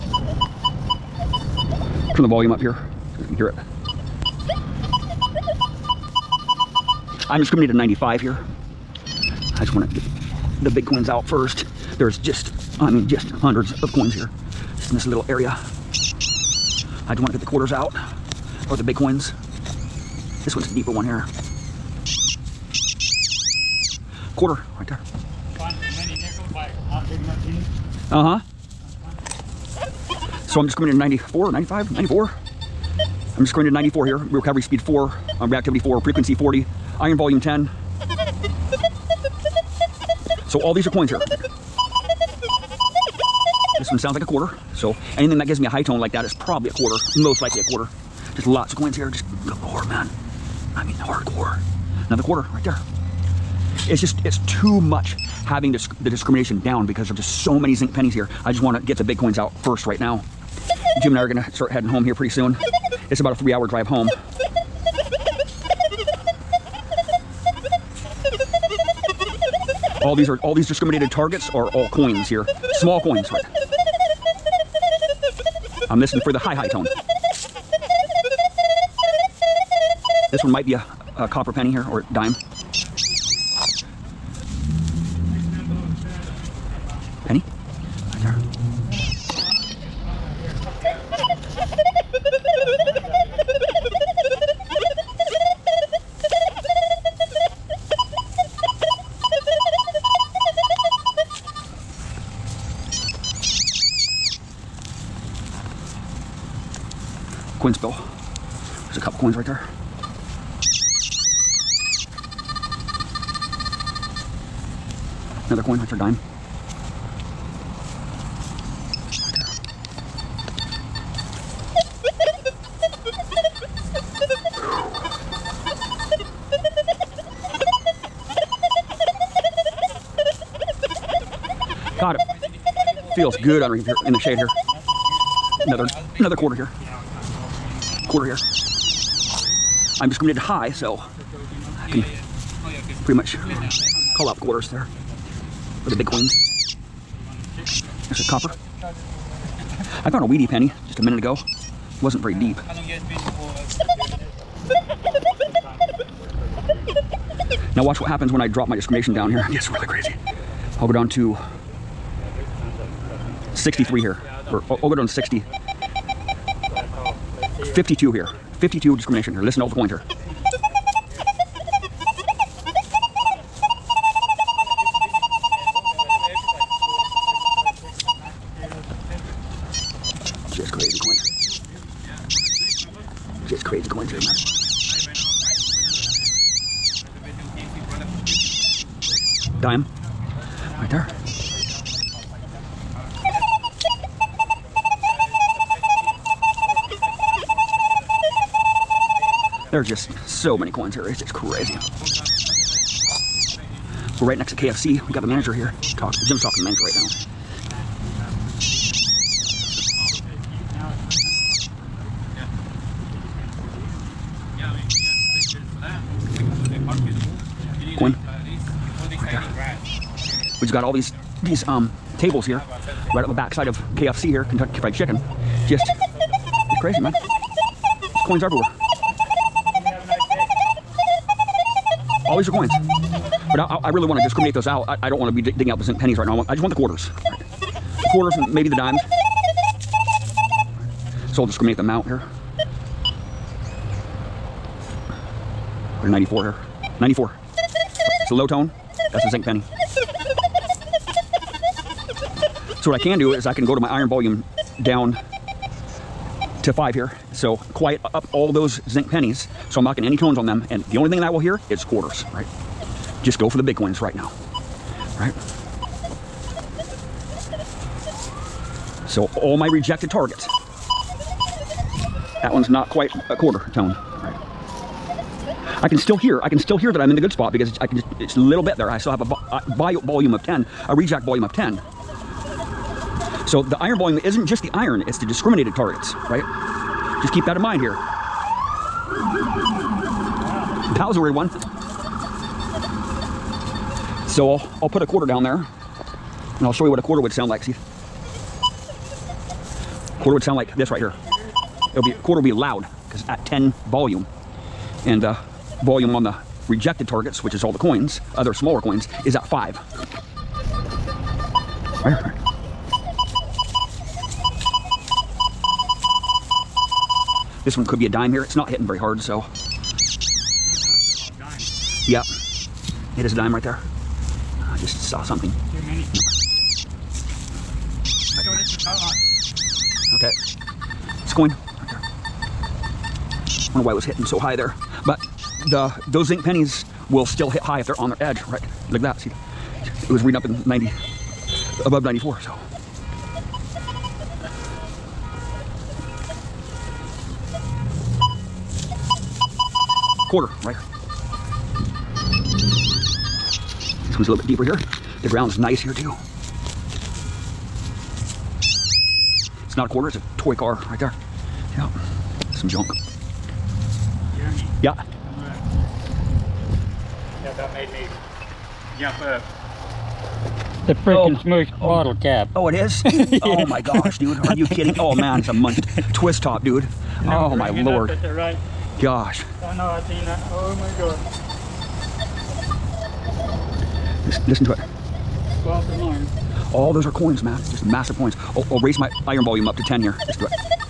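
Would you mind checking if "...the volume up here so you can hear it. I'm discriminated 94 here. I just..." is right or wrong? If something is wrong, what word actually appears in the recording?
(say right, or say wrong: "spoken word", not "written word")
wrong: "95", not "94".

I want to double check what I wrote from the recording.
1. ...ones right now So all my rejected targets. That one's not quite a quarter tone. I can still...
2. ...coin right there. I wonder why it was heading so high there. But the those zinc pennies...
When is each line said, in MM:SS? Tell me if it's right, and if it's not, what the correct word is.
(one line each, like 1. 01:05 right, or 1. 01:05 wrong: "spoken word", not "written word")
1. 04:23 right
2. 05:31 wrong: "hitting", not "heading".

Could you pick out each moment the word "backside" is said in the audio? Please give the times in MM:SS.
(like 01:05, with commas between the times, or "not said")
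03:43.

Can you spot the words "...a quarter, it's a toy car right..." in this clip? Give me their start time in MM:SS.
05:59.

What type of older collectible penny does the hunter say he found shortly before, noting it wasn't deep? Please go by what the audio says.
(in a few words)
wheatie penny.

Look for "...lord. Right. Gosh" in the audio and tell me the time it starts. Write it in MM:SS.
06:17.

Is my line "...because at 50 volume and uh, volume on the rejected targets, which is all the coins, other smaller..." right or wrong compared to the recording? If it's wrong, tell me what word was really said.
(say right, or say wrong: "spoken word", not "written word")
wrong: "10", not "50".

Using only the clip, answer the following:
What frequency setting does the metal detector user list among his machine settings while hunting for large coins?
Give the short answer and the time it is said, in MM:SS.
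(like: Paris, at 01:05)
40, at 00:35.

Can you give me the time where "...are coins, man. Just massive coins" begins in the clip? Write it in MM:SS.
06:27.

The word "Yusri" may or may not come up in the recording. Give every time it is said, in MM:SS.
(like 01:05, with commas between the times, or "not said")
not said.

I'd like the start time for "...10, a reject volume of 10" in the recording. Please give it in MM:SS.
04:40.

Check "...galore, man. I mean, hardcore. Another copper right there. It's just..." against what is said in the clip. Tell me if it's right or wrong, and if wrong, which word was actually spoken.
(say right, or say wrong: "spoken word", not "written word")
wrong: "quarter", not "copper".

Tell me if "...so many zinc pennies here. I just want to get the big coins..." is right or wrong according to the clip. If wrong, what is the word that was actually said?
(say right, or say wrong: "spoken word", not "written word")
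right.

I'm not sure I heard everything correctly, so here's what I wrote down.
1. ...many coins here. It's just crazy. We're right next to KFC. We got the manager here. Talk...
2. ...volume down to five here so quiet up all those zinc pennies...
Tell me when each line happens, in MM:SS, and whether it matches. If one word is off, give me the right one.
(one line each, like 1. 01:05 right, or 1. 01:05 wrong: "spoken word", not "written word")
1. 03:20 right
2. 04:14 right.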